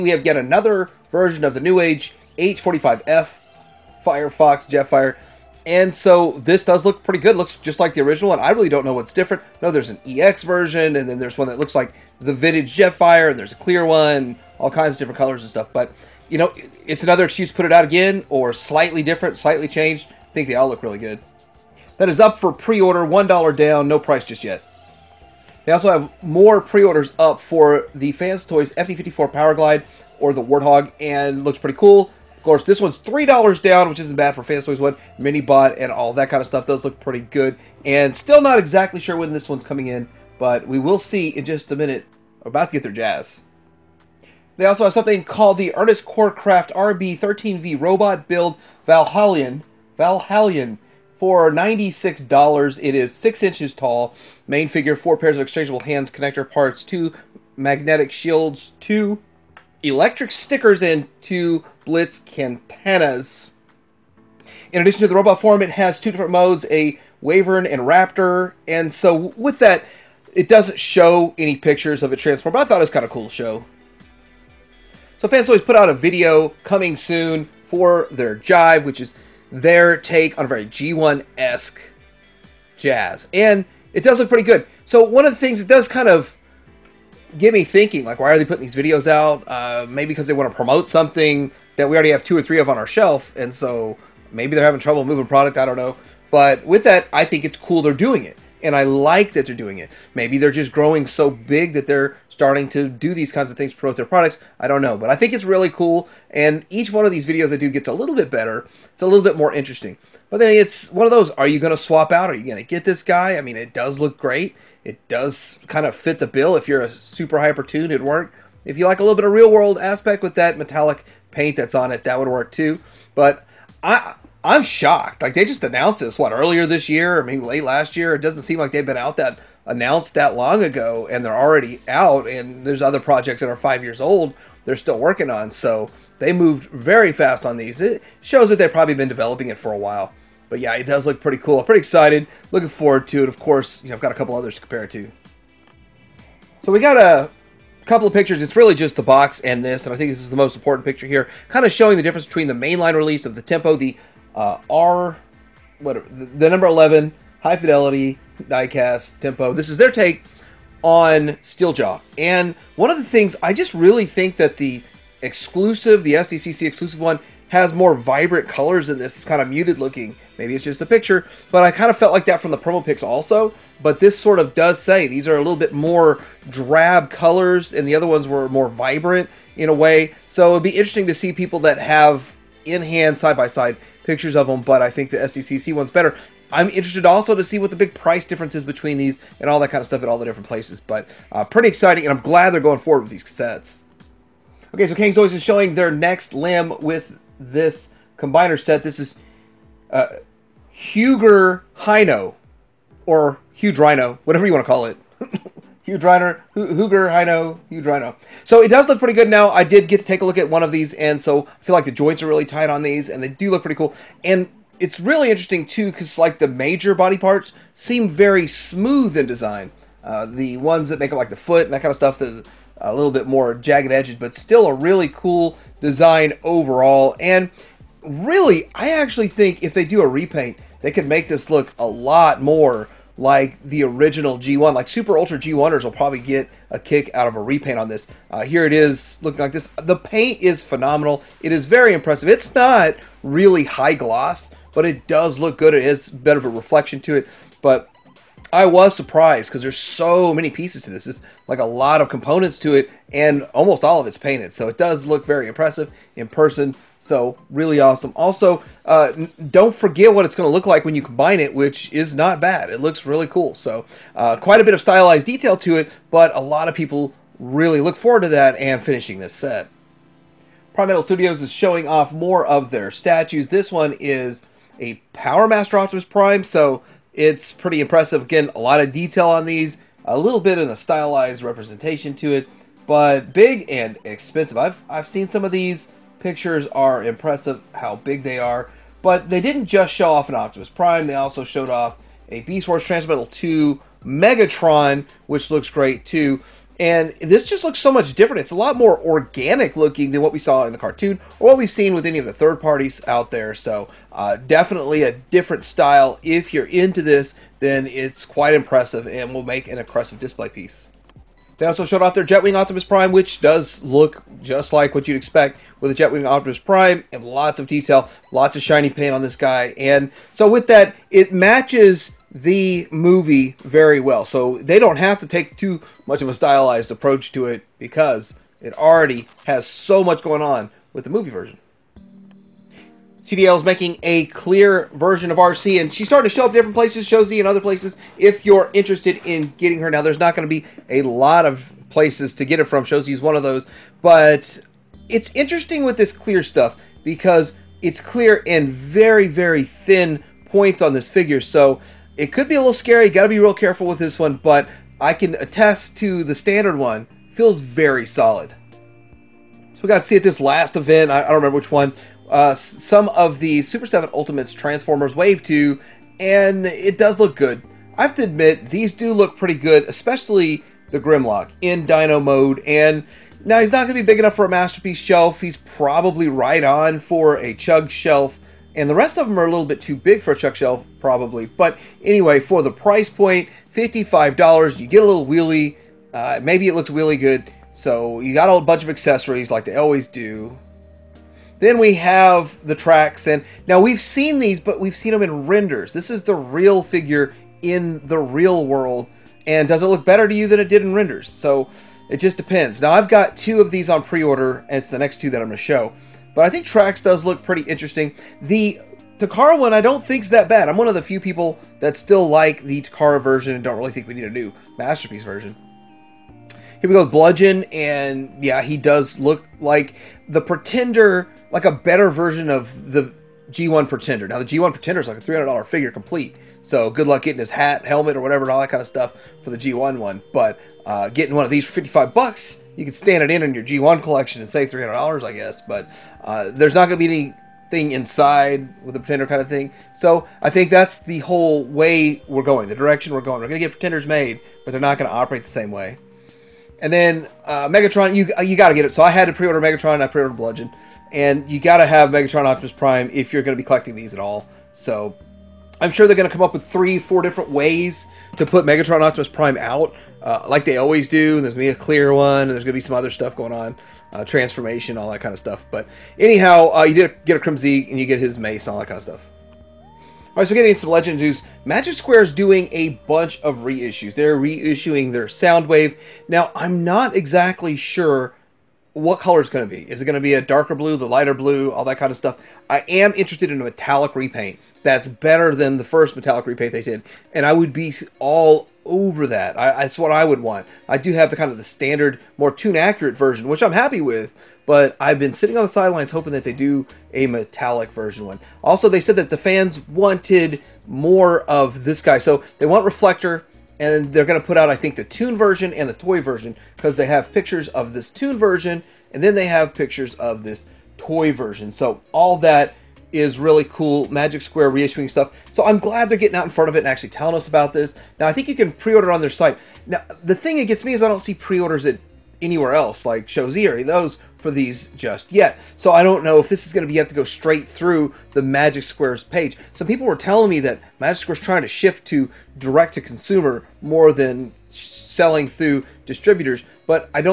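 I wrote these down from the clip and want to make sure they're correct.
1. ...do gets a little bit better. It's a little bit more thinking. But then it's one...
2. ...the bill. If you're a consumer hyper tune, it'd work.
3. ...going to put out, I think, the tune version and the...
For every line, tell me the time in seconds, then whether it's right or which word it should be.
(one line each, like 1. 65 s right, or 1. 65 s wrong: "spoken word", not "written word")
1. 107 s wrong: "interesting", not "thinking"
2. 116 s wrong: "super", not "consumer"
3. 504 s right.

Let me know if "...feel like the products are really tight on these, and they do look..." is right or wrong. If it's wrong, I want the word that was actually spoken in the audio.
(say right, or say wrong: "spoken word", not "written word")
wrong: "joints", not "products".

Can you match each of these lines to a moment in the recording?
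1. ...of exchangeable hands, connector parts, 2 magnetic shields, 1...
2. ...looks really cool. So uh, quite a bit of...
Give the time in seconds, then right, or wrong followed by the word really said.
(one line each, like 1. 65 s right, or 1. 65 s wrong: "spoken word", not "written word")
1. 55 s wrong: "2", not "1"
2. 262 s right.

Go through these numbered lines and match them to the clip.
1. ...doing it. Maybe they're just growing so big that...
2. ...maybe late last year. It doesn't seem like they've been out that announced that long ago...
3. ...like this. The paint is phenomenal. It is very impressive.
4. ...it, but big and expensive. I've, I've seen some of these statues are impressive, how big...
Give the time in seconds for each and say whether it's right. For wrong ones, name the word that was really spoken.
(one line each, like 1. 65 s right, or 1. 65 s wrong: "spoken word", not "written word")
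1. 99 s right
2. 127 s right
3. 239 s right
4. 282 s wrong: "pictures", not "statues".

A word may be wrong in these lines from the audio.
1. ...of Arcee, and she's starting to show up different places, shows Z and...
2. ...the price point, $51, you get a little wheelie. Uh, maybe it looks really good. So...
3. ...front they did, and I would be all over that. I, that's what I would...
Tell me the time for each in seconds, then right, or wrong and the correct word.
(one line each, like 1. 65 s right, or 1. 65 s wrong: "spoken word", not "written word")
1. 335 s right
2. 382 s wrong: "55", not "51"
3. 486 s wrong: "repaint", not "front".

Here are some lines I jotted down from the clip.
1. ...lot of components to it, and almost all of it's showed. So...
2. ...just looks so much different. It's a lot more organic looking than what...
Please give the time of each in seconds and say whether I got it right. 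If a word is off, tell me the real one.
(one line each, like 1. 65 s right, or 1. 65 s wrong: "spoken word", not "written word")
1. 251 s wrong: "painted", not "showed"
2. 297 s right.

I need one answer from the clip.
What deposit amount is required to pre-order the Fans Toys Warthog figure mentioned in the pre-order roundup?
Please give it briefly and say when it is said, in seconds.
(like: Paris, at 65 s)
$3, at 32 s.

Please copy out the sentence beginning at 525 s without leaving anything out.
So I don't know if this is going to be you have to go straight through the Magic Squares page.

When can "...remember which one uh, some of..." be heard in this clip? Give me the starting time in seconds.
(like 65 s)
361 s.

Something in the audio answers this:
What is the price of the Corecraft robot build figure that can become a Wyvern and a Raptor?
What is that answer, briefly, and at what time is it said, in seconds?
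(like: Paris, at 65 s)
$96, at 51 s.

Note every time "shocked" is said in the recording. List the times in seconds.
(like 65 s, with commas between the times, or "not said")
124 s.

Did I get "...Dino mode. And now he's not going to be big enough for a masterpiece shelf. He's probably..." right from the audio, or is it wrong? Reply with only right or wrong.
right.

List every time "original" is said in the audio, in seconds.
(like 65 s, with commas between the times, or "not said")
8 s, 233 s.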